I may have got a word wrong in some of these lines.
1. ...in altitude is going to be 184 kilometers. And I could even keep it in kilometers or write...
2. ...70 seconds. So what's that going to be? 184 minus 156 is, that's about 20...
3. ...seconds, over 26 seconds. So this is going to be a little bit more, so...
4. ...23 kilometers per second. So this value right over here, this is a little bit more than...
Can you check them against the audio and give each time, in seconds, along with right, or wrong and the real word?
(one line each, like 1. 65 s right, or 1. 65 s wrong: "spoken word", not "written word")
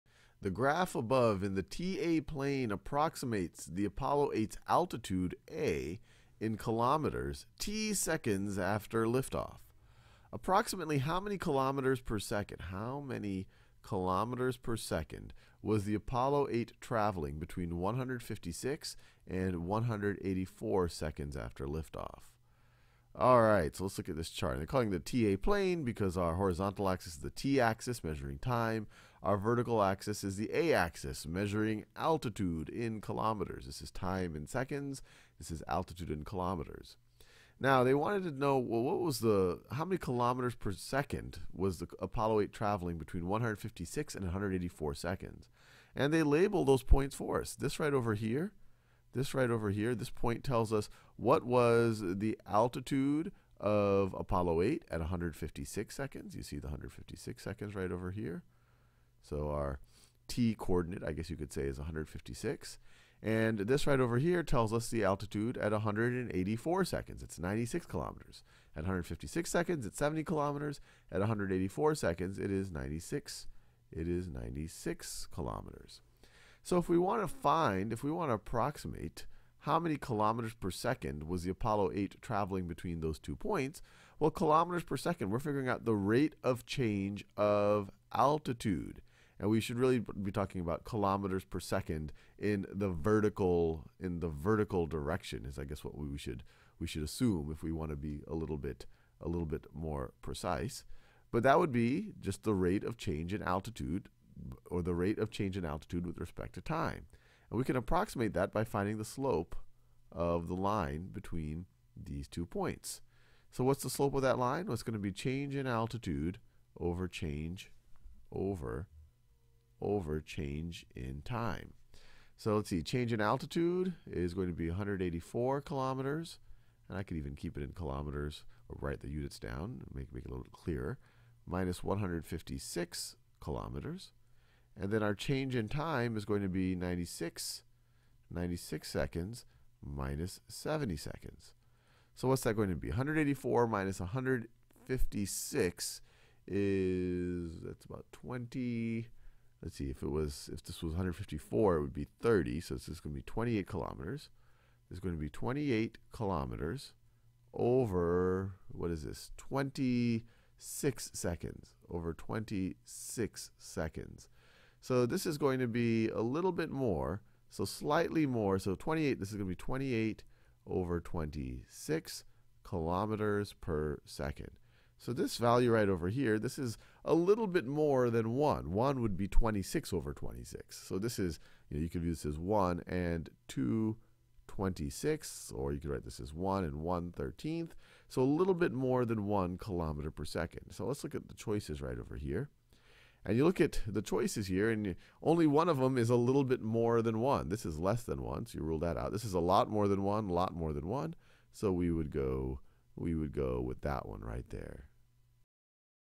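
1. 123 s right
2. 140 s right
3. 161 s right
4. 170 s wrong: "26", not "23".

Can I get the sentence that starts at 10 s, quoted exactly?
Approximately how many kilometers per second?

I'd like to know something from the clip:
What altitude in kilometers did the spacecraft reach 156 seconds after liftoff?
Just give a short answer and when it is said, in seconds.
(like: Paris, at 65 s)
70 kilometers, at 69 s.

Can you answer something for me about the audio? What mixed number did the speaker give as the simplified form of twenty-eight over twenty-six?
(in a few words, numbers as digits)
1 and 1/13.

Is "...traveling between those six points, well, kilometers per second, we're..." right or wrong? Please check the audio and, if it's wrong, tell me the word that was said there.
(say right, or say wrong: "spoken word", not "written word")
wrong: "two", not "six".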